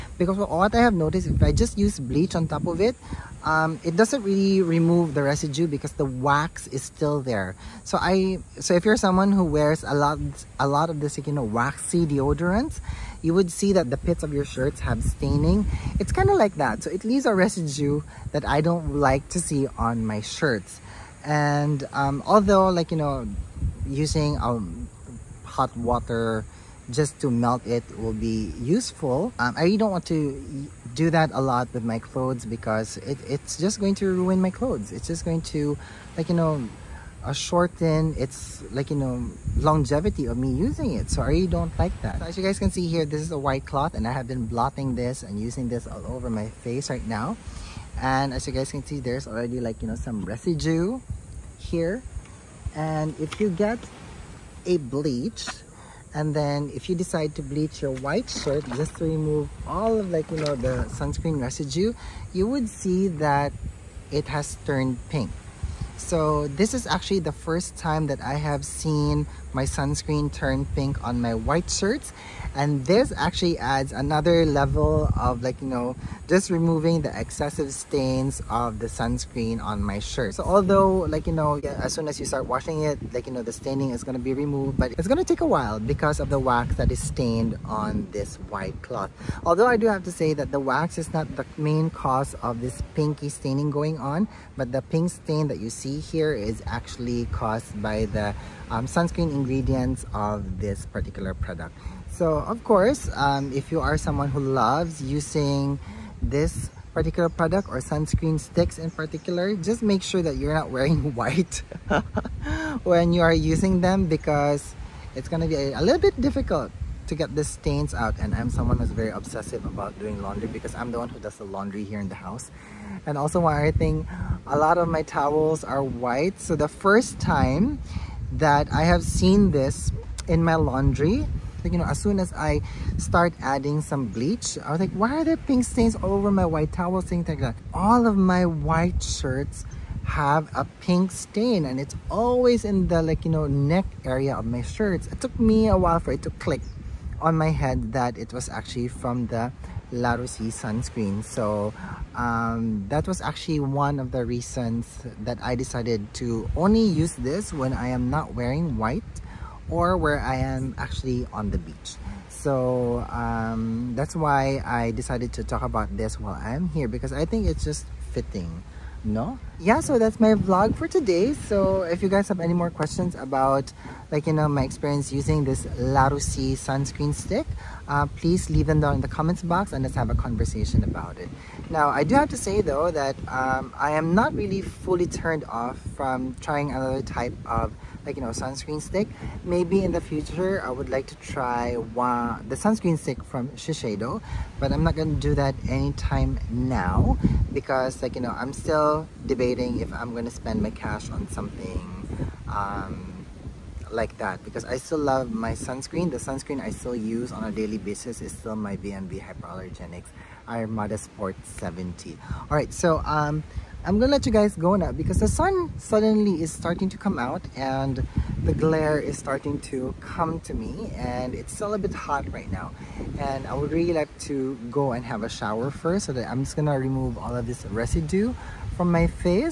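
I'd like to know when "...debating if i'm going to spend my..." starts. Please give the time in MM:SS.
03:19.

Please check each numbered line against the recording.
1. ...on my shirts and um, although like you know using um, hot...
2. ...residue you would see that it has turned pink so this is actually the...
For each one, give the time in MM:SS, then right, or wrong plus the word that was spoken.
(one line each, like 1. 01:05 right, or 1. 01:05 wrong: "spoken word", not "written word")
1. 00:19 right
2. 01:01 right.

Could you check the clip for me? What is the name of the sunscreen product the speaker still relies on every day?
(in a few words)
VMV Hypoallergenics Armada Sport 70.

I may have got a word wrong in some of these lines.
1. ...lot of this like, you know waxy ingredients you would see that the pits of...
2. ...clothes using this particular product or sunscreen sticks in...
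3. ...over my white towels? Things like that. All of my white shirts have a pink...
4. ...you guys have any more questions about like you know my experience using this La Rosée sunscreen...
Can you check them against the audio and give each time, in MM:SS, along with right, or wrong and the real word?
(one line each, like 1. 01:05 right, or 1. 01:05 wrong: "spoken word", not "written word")
1. 00:10 wrong: "deodorants", not "ingredients"
2. 01:44 wrong: "loves", not "clothes"
3. 02:16 right
4. 02:52 right.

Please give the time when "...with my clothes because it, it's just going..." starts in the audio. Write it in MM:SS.
00:31.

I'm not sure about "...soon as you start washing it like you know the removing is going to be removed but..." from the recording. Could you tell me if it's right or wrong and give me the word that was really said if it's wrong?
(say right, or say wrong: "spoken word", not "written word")
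wrong: "staining", not "removing".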